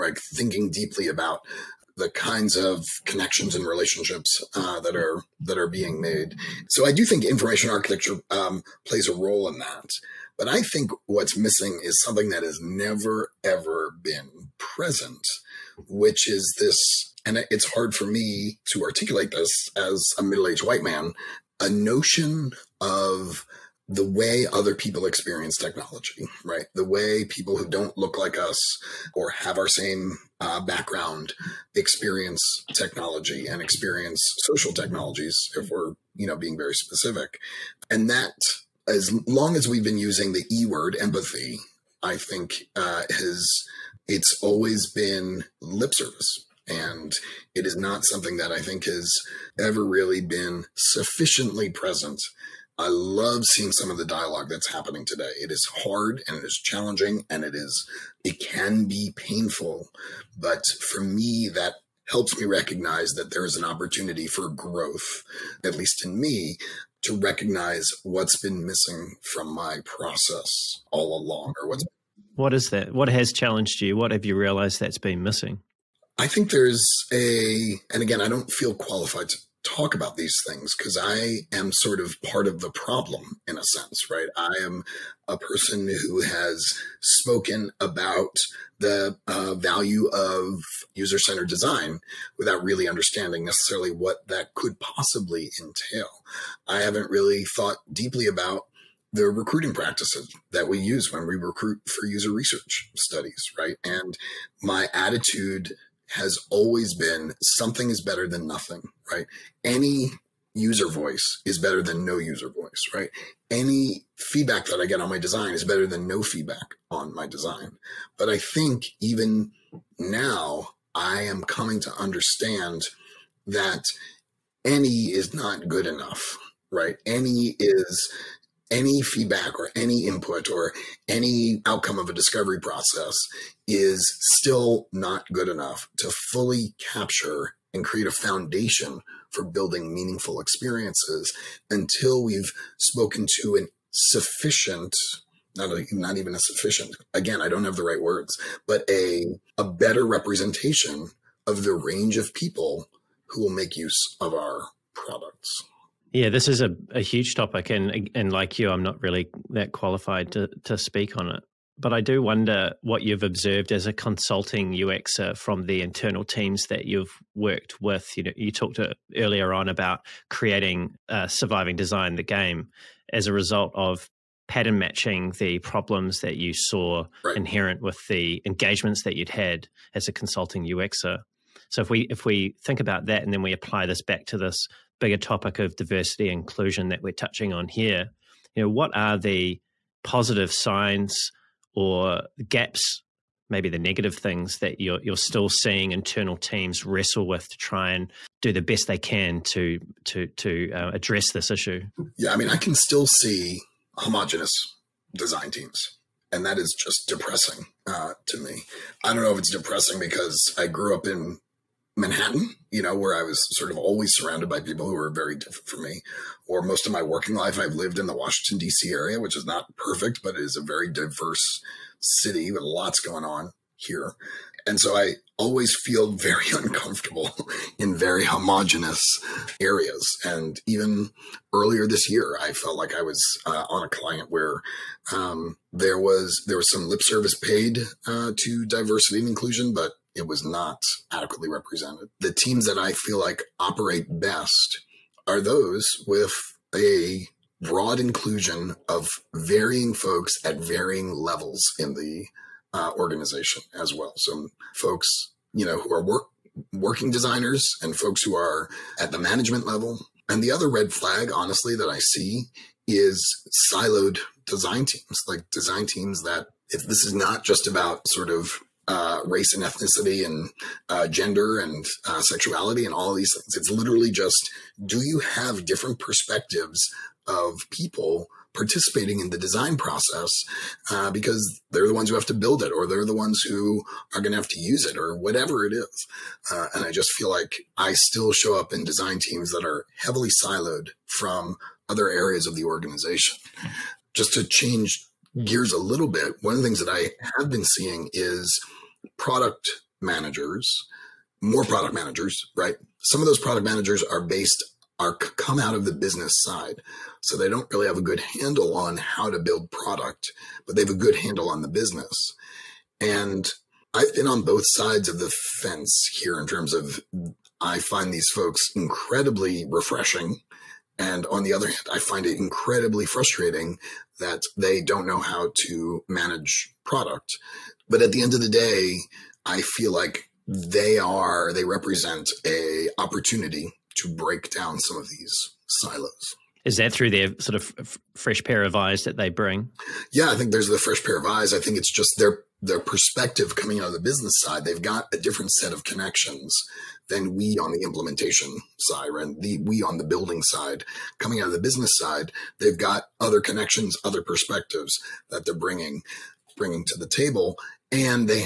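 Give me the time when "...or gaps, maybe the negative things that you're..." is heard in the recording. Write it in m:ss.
3:11.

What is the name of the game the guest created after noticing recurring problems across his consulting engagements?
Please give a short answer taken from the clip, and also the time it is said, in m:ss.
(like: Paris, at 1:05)
Surviving Design, at 2:51.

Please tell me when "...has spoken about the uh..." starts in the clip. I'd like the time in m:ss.
1:26.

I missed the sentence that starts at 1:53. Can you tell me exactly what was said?
Any feedback that I get on my design is better than no feedback on my design.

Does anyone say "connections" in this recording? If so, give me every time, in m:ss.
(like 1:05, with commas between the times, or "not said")
0:03, 5:45, 5:53.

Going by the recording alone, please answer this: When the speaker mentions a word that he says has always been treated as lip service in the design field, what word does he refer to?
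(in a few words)
empathy.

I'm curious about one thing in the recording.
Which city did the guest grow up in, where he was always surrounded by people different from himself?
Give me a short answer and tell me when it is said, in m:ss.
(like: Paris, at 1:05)
Manhattan, at 3:31.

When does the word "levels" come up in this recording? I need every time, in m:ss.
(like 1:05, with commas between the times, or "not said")
4:11, 4:19.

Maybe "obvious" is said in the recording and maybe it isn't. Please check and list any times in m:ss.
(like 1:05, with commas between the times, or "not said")
not said.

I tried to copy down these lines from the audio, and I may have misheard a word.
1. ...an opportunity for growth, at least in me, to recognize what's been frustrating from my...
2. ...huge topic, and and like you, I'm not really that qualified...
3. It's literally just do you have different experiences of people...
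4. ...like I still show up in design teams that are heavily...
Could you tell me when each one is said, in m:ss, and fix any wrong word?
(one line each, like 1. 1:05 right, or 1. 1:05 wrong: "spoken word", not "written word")
1. 1:03 wrong: "missing", not "frustrating"
2. 2:36 right
3. 4:33 wrong: "perspectives", not "experiences"
4. 4:47 right.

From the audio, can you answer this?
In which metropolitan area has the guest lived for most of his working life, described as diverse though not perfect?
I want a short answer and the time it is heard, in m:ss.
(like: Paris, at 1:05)
Washington, D.C., at 3:38.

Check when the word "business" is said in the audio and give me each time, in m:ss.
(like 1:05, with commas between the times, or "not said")
5:05, 5:11, 5:43, 5:51.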